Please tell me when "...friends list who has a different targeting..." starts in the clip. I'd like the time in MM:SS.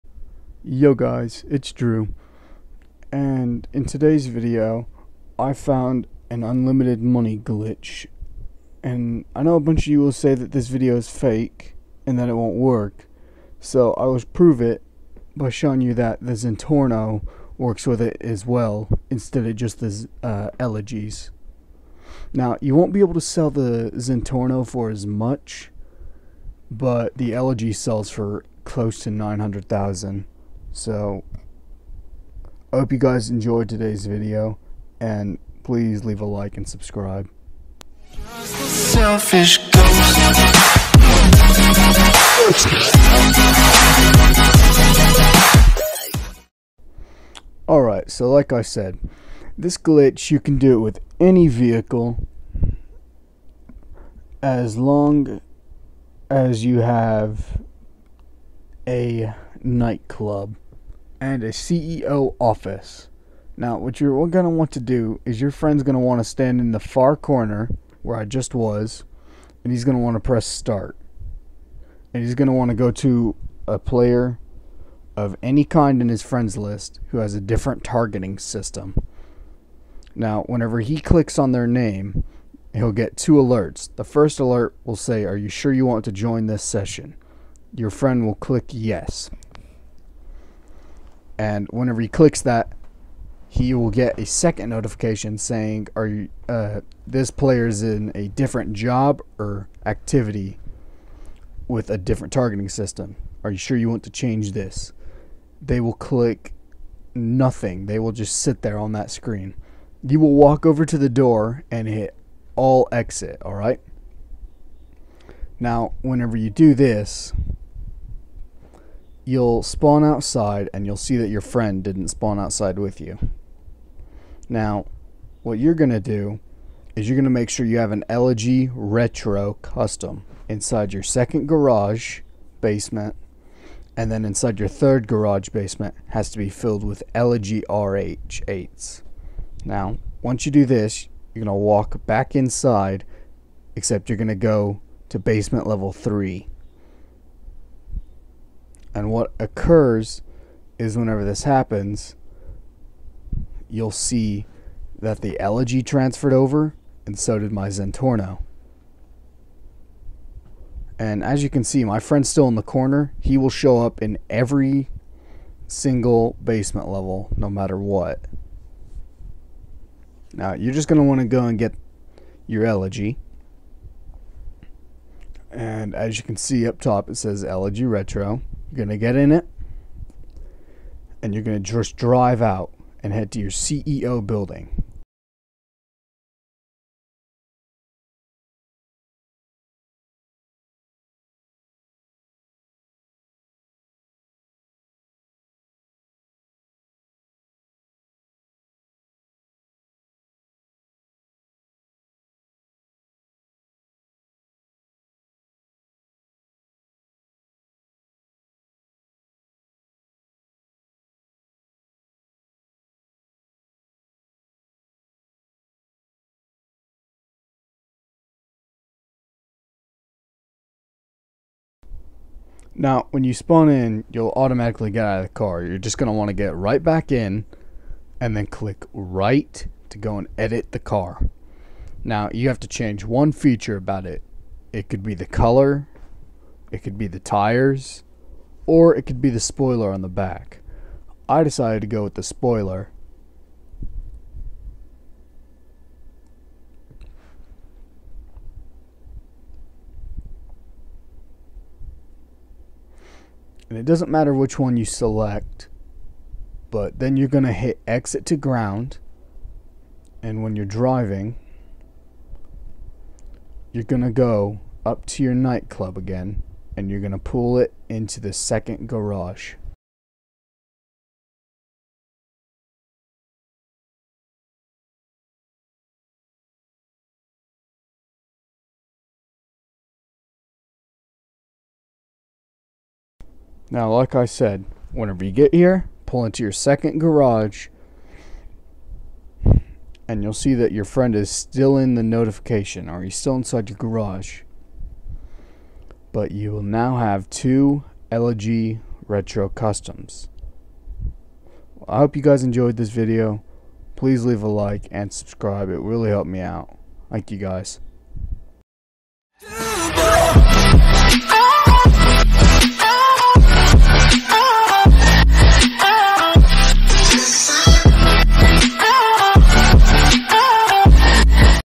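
01:16.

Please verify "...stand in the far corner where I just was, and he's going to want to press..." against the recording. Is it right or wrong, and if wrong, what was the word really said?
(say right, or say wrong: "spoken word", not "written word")
right.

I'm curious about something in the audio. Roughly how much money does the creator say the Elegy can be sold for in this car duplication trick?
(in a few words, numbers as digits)
900,000.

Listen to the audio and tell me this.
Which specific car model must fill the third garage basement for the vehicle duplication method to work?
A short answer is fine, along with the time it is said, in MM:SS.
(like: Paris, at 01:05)
Elegy RH8, at 02:17.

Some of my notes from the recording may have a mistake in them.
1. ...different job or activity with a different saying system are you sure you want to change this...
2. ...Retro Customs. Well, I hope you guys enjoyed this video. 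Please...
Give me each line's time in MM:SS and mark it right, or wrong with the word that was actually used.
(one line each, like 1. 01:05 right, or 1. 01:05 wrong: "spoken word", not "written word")
1. 01:38 wrong: "targeting", not "saying"
2. 04:59 right.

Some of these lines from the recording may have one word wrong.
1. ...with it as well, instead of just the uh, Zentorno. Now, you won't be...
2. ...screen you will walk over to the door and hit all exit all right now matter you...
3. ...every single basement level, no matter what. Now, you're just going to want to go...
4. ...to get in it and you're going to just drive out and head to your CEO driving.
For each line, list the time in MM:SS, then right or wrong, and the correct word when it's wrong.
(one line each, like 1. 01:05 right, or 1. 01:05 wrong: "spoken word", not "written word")
1. 00:17 wrong: "Elegies", not "Zentorno"
2. 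01:49 wrong: "whenever", not "matter"
3. 02:44 right
4. 02:58 wrong: "building", not "driving".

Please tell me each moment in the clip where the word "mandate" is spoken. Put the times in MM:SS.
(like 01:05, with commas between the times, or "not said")
not said.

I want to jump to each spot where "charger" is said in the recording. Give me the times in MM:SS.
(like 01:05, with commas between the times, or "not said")
not said.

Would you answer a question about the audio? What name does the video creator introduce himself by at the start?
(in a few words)
Jrue.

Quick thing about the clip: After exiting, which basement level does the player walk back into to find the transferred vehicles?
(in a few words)
Basement level 3.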